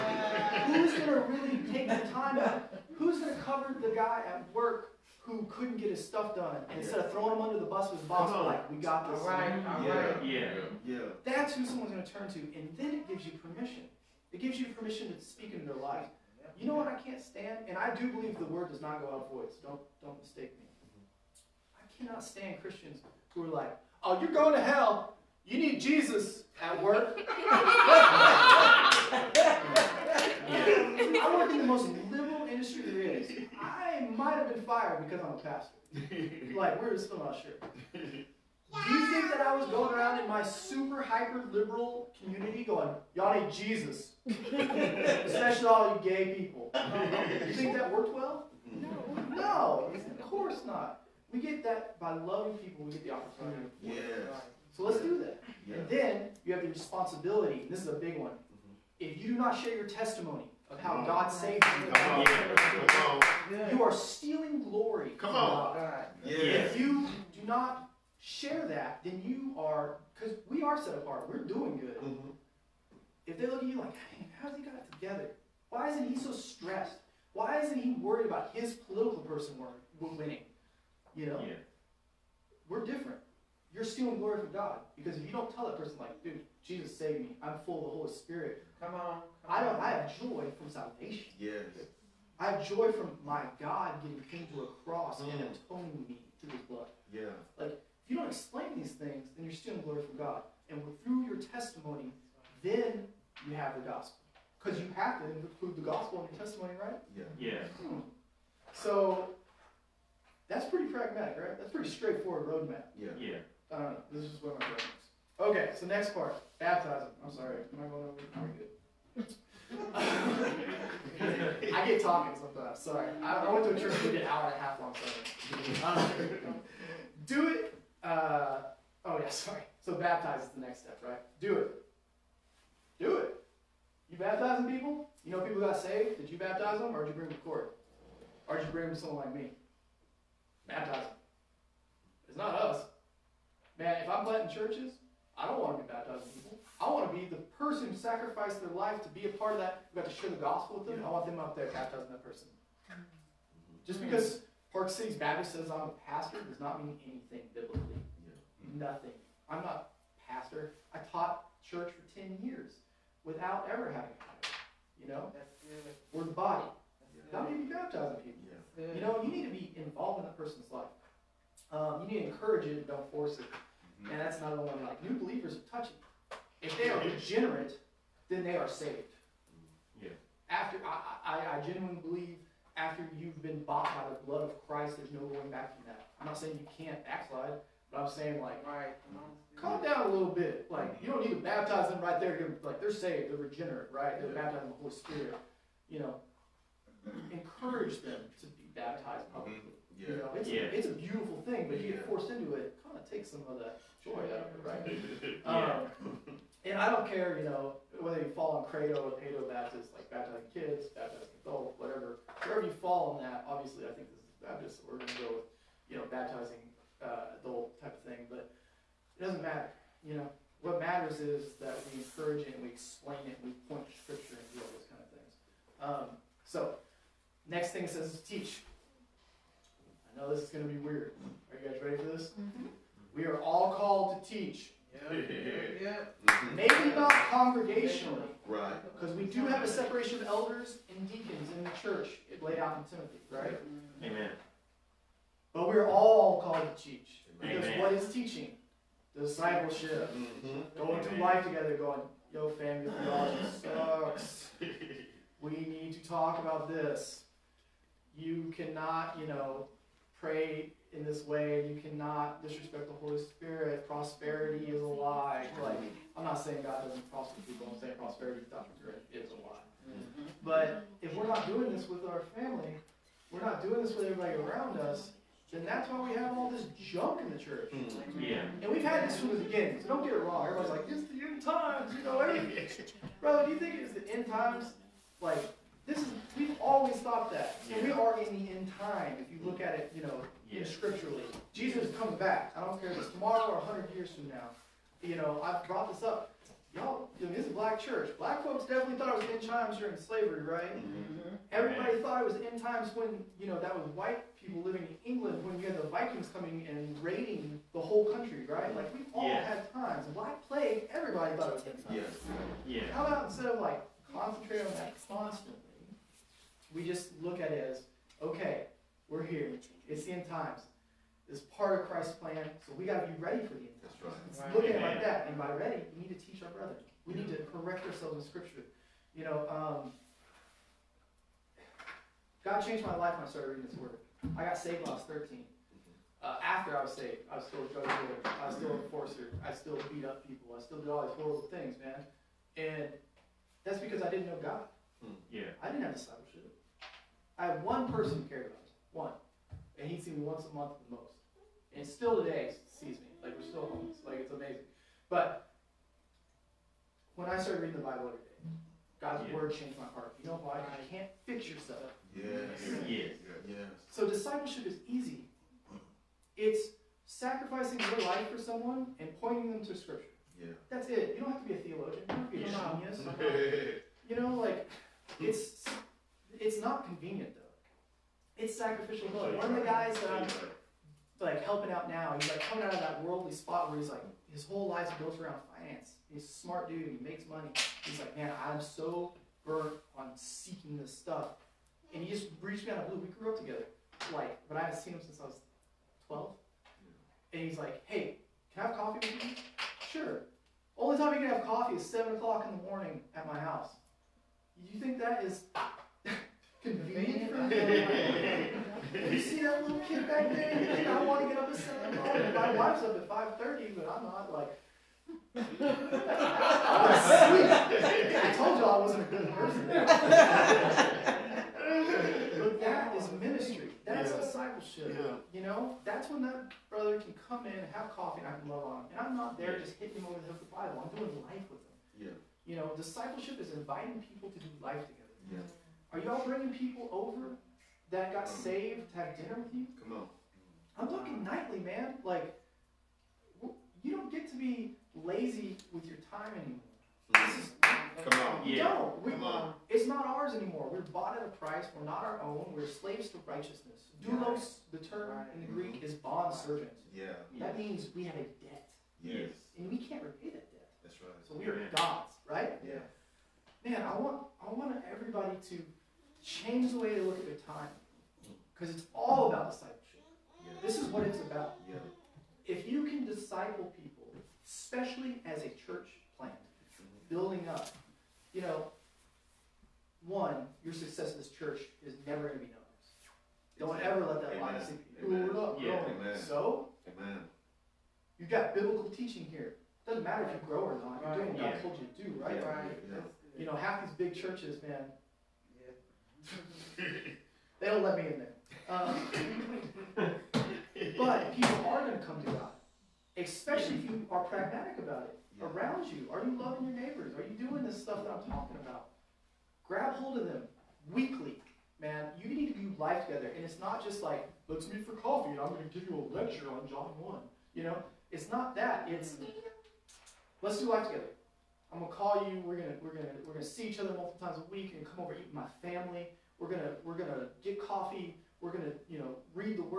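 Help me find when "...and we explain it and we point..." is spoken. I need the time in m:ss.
3:42.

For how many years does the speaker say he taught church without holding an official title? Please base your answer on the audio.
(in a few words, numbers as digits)
10.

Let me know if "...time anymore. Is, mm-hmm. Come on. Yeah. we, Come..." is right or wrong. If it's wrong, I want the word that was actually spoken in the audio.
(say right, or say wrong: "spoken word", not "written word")
right.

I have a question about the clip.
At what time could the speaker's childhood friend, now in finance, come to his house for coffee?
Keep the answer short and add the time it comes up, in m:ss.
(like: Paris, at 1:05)
7 o'clock, at 6:41.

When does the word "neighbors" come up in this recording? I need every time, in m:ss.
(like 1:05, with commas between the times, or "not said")
8:26.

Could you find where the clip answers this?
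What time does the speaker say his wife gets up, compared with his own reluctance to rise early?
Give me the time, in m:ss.
6:53.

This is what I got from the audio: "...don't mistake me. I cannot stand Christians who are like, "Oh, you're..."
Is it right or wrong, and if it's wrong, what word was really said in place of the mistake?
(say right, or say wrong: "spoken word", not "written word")
right.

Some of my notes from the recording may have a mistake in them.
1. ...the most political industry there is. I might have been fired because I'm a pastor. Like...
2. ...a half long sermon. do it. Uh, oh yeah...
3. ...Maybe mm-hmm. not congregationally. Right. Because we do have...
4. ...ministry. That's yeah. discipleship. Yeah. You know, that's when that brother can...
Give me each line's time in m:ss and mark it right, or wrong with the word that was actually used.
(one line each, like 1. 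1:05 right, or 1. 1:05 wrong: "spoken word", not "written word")
1. 0:31 wrong: "liberal", not "political"
2. 2:04 right
3. 3:56 right
4. 7:03 right.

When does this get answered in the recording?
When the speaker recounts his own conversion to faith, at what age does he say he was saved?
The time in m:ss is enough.
5:35.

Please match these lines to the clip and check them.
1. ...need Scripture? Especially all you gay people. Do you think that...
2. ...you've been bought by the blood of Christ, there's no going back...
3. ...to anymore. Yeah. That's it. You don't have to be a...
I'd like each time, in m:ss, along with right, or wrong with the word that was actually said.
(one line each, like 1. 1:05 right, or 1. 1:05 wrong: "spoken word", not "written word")
1. 0:43 wrong: "Jesus", not "Scripture"
2. 3:03 right
3. 6:09 wrong: "scripture", not "anymore".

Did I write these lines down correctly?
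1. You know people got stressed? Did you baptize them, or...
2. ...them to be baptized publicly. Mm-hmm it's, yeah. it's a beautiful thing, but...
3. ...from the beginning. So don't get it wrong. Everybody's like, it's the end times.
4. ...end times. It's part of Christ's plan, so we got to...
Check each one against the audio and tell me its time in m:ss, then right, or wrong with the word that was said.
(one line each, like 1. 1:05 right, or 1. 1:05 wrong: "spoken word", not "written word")
1. 2:15 wrong: "saved", not "stressed"
2. 3:18 right
3. 4:39 right
4. 5:20 right.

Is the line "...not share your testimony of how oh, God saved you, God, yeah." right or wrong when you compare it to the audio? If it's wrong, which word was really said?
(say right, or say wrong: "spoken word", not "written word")
right.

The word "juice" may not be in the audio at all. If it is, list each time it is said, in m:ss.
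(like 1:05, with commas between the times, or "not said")
not said.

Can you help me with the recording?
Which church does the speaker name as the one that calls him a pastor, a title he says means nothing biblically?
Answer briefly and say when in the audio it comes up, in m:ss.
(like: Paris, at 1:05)
Park Cities Baptist, at 2:34.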